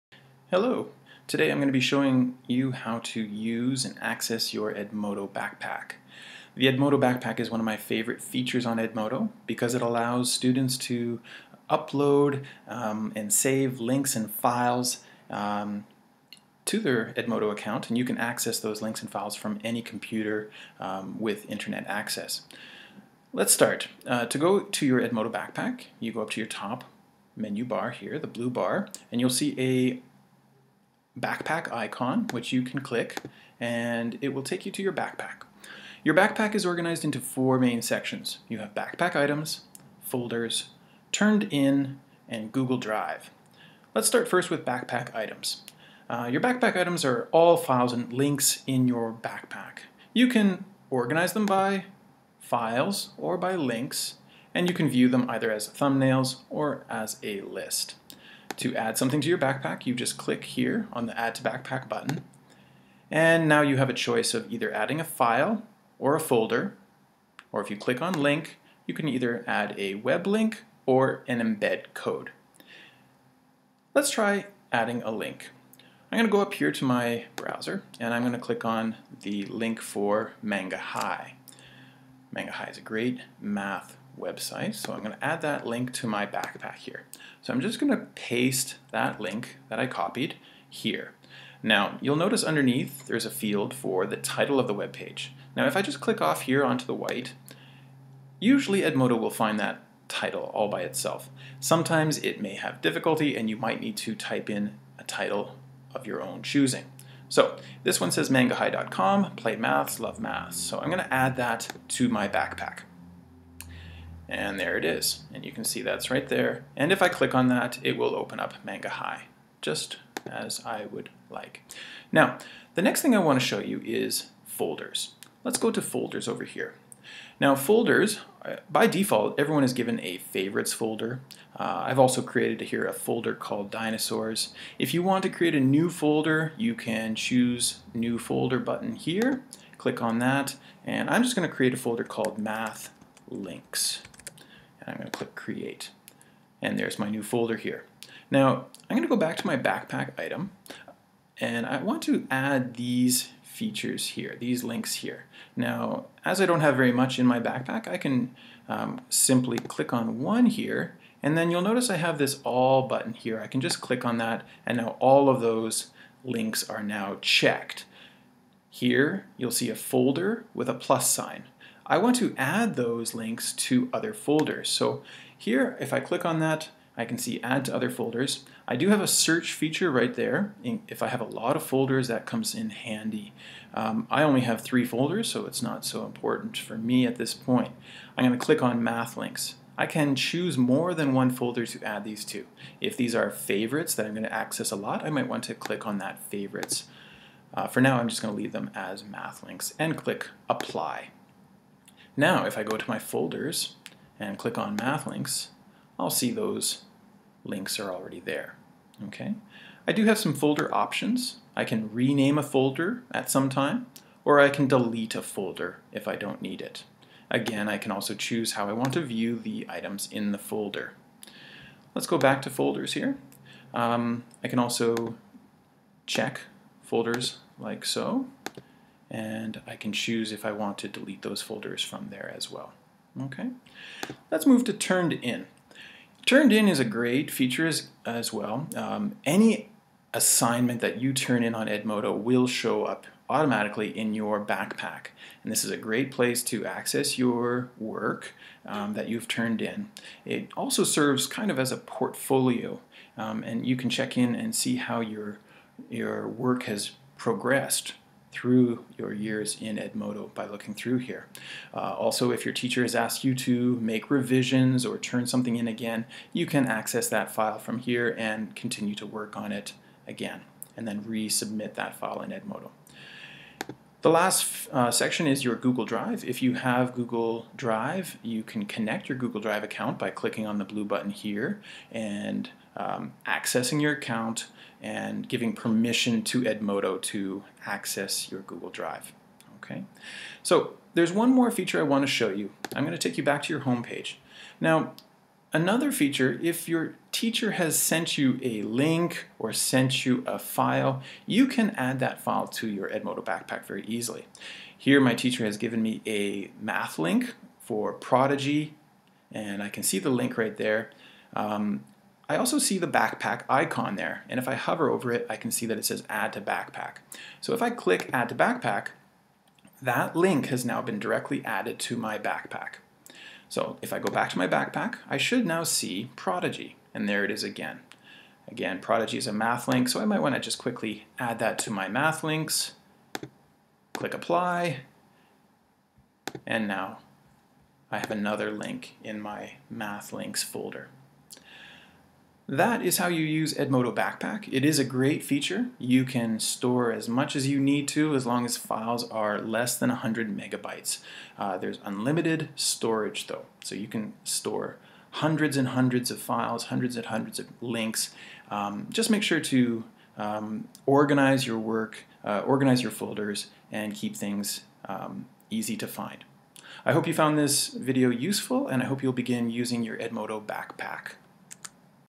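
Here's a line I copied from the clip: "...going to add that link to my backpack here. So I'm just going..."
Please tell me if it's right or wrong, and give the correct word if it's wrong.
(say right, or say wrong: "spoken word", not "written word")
right.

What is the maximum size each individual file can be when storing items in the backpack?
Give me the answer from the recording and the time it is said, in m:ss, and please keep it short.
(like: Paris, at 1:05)
100 megabytes, at 5:49.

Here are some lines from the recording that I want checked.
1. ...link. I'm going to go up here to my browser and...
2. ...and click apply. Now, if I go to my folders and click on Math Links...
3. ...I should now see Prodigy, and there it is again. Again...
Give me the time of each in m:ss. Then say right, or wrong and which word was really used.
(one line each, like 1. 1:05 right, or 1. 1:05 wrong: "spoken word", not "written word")
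1. 1:15 right
2. 3:19 right
3. 5:25 right.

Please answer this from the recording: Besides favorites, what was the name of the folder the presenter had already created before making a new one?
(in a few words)
dinosaurs.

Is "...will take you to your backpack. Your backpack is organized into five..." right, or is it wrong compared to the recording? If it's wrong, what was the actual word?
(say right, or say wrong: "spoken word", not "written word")
wrong: "four", not "five".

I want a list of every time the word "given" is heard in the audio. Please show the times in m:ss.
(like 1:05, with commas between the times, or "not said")
2:09, 5:05.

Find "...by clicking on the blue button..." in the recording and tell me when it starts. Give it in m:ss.
4:39.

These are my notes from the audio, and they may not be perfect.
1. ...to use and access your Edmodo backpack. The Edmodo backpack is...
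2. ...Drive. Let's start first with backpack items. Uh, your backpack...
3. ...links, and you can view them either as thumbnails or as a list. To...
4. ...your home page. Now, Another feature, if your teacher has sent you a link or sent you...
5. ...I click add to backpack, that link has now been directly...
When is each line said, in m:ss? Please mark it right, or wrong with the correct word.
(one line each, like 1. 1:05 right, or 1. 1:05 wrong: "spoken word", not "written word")
1. 0:03 right
2. 0:42 right
3. 0:53 right
4. 4:53 right
5. 5:17 right.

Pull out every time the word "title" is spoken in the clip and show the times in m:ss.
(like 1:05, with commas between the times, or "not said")
1:34, 1:40, 1:45.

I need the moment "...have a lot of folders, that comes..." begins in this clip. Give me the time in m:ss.
3:01.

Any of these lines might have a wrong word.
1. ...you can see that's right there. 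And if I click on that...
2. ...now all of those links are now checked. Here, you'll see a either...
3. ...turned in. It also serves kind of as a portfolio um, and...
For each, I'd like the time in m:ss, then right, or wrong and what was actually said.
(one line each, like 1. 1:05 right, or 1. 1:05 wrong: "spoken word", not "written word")
1. 1:55 right
2. 2:44 wrong: "folder", not "either"
3. 4:09 right.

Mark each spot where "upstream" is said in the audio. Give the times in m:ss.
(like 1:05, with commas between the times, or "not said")
not said.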